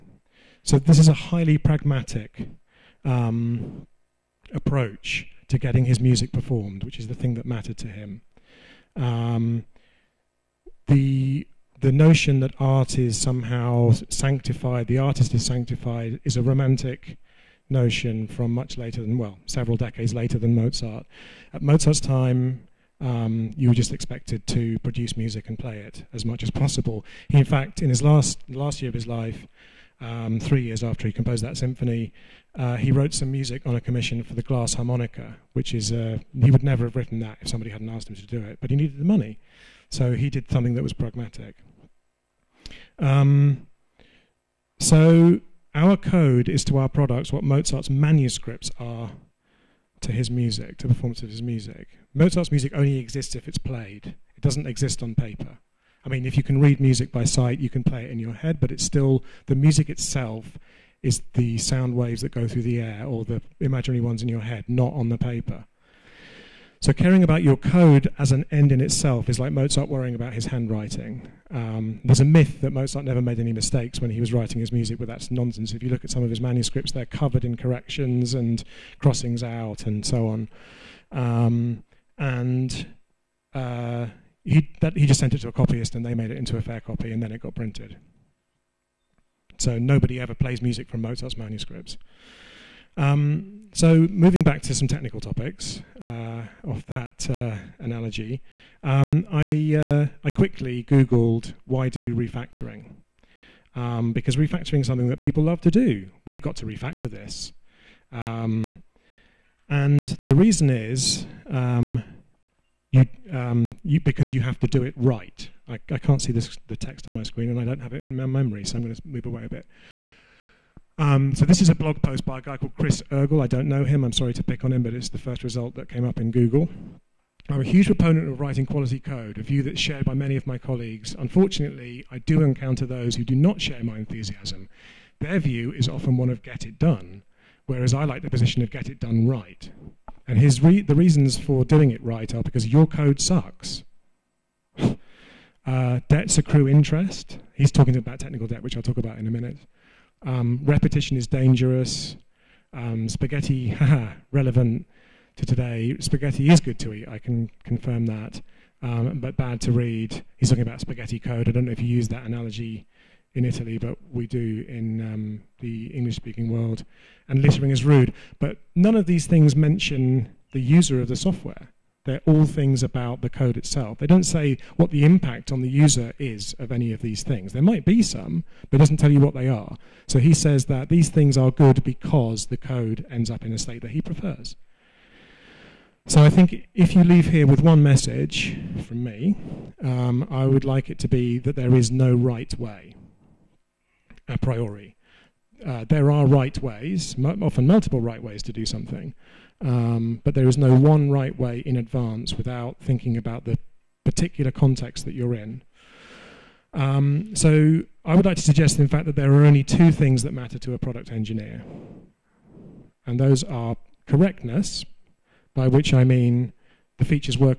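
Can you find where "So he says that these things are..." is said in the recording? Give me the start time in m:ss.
3:00.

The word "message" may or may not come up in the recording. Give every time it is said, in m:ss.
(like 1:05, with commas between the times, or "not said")
3:07.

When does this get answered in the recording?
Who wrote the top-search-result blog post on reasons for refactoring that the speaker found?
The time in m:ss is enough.
2:02.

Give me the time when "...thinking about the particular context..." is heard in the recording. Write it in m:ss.
3:22.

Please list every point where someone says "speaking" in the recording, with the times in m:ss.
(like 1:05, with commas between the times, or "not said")
2:46.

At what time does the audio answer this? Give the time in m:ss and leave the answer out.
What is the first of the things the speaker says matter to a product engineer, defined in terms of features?
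3:34.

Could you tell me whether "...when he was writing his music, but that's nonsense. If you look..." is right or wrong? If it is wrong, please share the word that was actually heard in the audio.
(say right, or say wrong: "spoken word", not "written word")
right.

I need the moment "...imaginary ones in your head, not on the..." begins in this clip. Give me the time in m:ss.
1:03.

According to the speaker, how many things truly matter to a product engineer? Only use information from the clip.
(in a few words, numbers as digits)
2.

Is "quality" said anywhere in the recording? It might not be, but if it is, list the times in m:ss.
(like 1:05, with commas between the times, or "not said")
2:08.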